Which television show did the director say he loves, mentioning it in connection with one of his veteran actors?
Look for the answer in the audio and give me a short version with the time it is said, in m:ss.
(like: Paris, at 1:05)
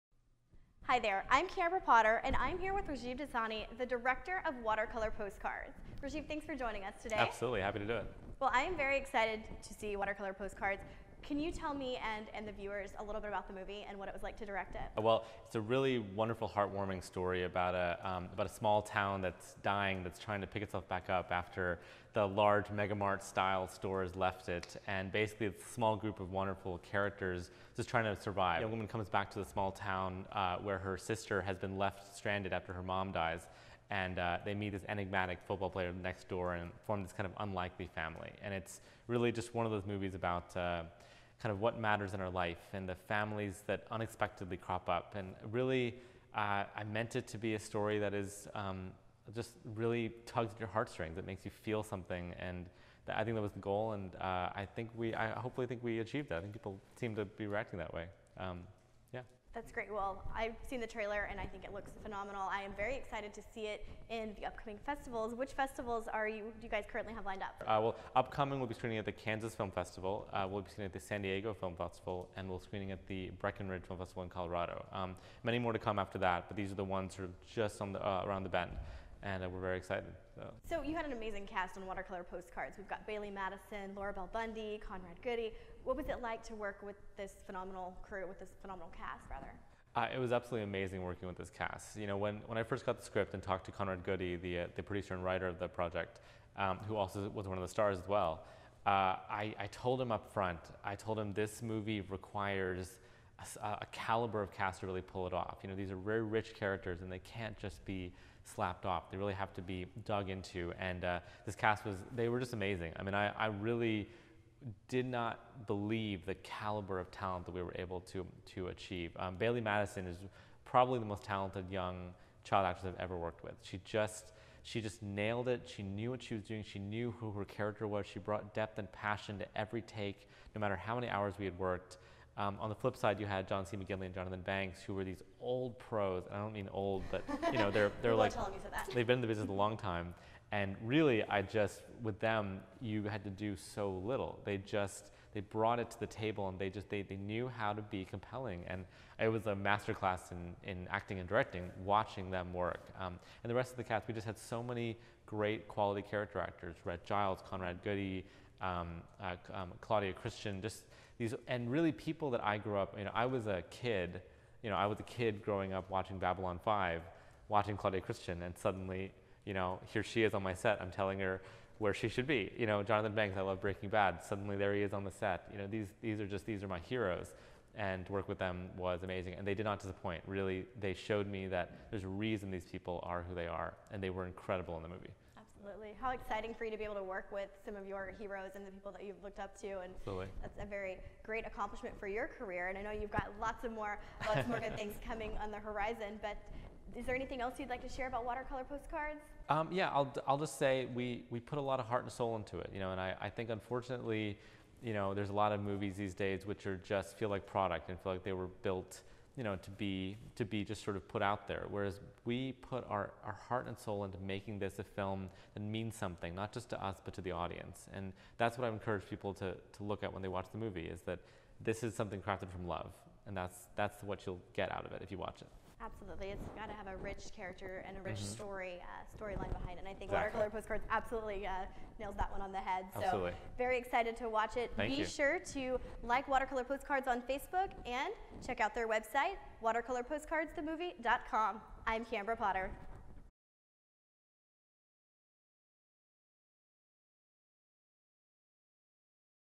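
Breaking Bad, at 2:53.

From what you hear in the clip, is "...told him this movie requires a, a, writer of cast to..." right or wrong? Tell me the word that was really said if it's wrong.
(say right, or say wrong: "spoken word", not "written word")
wrong: "caliber", not "writer".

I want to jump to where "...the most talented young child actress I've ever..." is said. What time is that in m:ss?
2:00.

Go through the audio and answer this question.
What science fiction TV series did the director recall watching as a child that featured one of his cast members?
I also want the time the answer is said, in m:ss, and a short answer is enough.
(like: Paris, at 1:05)
Babylon 5, at 2:46.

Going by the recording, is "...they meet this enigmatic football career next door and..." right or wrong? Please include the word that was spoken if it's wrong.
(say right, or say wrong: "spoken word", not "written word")
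wrong: "player", not "career".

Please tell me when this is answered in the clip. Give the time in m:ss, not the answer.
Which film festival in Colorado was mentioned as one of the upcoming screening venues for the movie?
1:13.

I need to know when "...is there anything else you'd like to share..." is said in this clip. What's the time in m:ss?
3:16.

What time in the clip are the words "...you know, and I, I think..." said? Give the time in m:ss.
3:22.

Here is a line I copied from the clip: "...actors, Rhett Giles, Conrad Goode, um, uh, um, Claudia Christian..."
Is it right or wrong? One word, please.
right.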